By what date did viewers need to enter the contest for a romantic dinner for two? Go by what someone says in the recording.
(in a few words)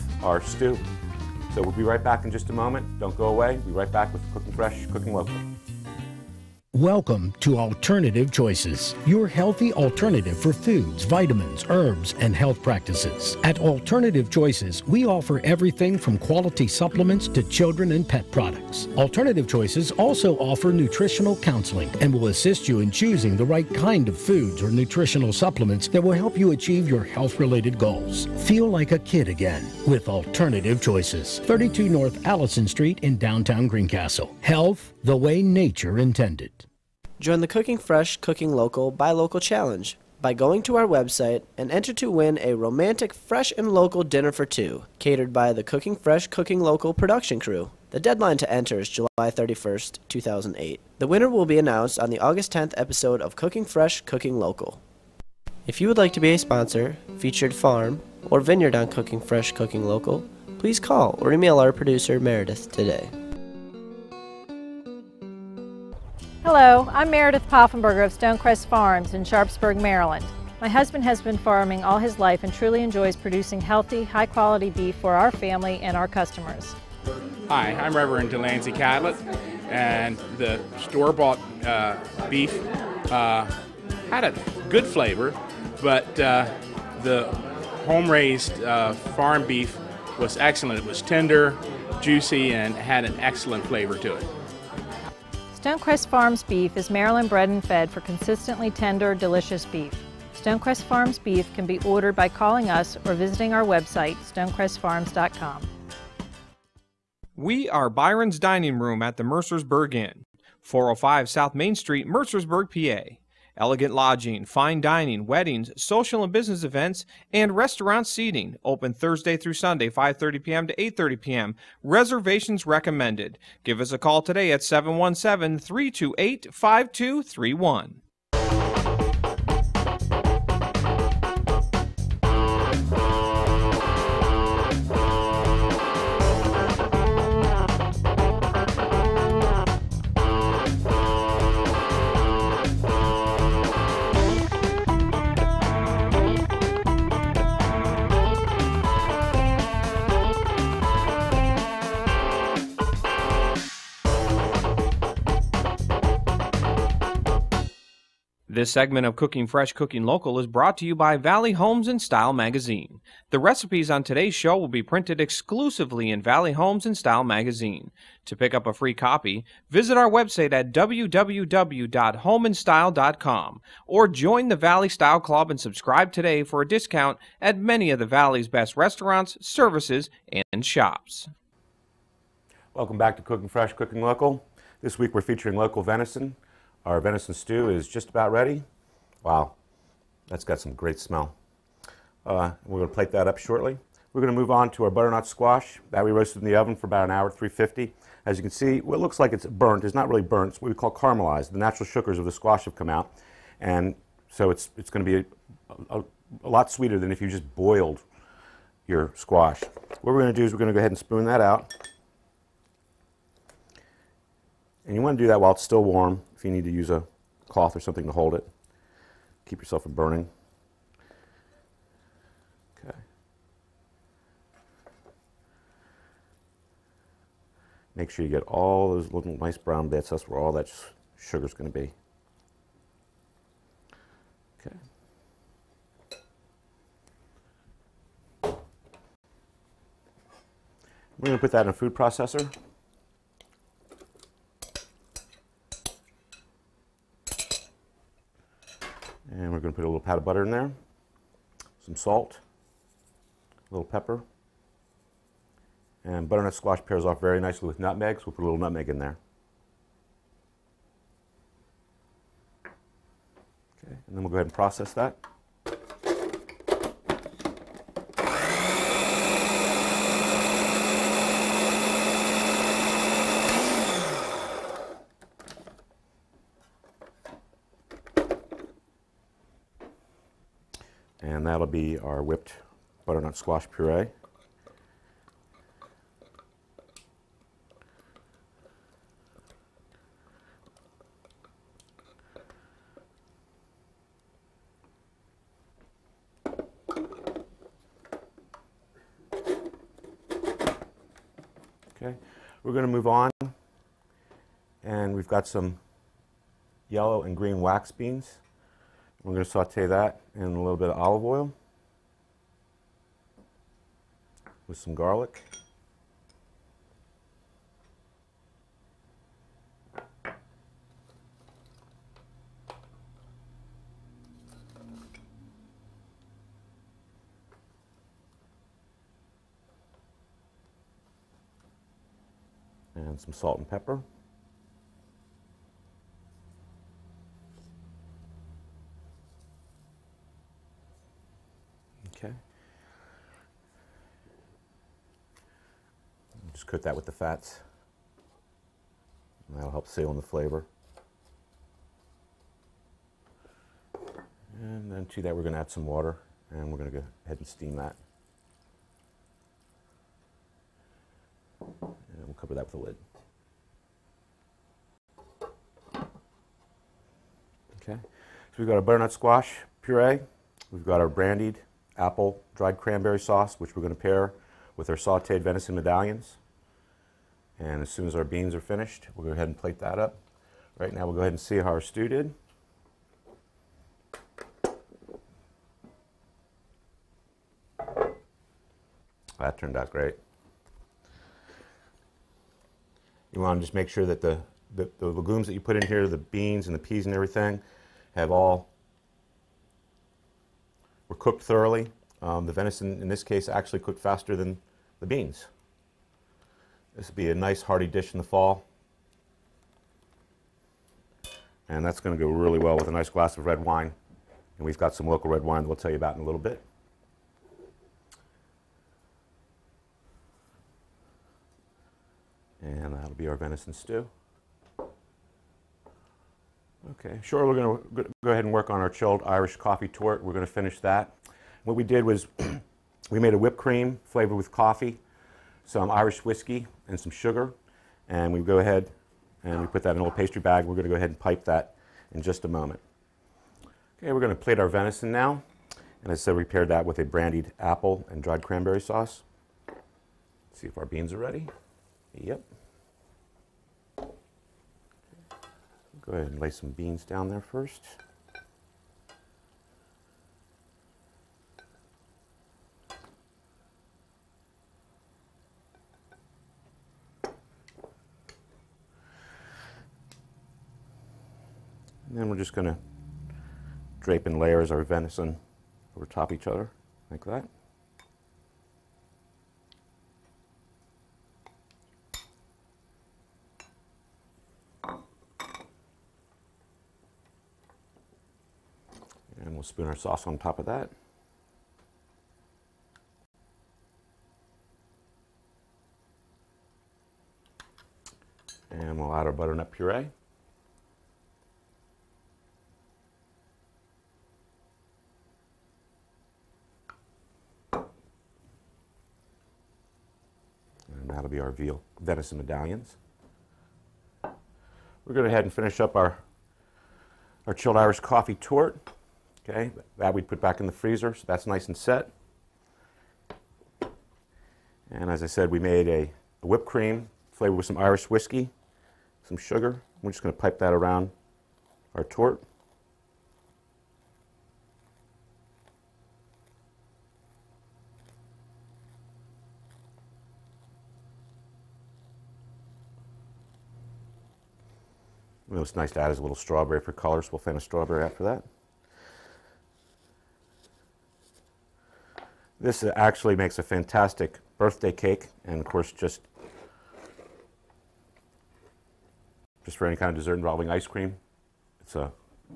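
July 31st, 2008.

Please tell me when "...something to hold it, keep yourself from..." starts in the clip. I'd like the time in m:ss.
3:37.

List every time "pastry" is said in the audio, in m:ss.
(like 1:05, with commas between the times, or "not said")
7:20.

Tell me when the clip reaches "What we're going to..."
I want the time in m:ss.
3:30.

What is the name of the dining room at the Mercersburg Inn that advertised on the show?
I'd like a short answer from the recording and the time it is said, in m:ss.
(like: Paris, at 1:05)
Byron's Dining Room, at 1:47.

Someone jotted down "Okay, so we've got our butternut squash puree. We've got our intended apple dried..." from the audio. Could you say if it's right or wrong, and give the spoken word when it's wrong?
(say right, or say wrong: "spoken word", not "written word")
wrong: "brandied", not "intended".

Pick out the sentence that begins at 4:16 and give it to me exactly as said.
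And butternut squash pairs off very nicely with nutmeg, so we'll put a little nutmeg in there.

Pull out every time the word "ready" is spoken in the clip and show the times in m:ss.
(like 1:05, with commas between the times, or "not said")
3:08, 7:31.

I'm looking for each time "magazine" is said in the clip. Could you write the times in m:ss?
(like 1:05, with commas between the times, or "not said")
2:42, 2:47.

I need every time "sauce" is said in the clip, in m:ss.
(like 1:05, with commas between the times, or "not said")
6:13, 7:28, 8:09.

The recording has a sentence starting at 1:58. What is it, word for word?
Open Thursday through Sunday, 5:30 p.m.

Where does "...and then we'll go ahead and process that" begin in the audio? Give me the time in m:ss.
4:24.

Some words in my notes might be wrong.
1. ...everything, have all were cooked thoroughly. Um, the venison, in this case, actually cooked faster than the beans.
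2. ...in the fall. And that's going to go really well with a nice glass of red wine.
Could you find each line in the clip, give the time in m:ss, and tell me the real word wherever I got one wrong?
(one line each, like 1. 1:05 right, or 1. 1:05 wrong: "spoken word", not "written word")
1. 6:37 right
2. 6:48 right.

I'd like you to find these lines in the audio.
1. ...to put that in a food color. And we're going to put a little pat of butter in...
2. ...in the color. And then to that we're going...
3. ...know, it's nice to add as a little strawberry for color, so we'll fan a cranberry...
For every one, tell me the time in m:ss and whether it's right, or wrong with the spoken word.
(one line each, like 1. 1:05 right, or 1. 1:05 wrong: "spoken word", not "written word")
1. 4:01 wrong: "processor", not "color"
2. 5:50 wrong: "flavor", not "color"
3. 9:05 wrong: "strawberry", not "cranberry".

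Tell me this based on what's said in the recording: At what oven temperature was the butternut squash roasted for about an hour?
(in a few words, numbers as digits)
350.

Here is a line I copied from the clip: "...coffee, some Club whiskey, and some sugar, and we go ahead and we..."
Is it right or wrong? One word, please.
wrong.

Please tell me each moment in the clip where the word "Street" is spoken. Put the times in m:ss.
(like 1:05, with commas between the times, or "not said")
0:32, 1:51.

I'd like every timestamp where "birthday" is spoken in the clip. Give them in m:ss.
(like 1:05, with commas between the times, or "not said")
9:14.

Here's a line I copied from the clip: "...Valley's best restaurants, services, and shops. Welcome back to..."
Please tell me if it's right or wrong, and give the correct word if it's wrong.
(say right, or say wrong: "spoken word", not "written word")
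right.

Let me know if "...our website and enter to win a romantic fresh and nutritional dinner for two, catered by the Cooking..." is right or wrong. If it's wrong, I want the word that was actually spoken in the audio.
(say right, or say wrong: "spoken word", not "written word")
wrong: "local", not "nutritional".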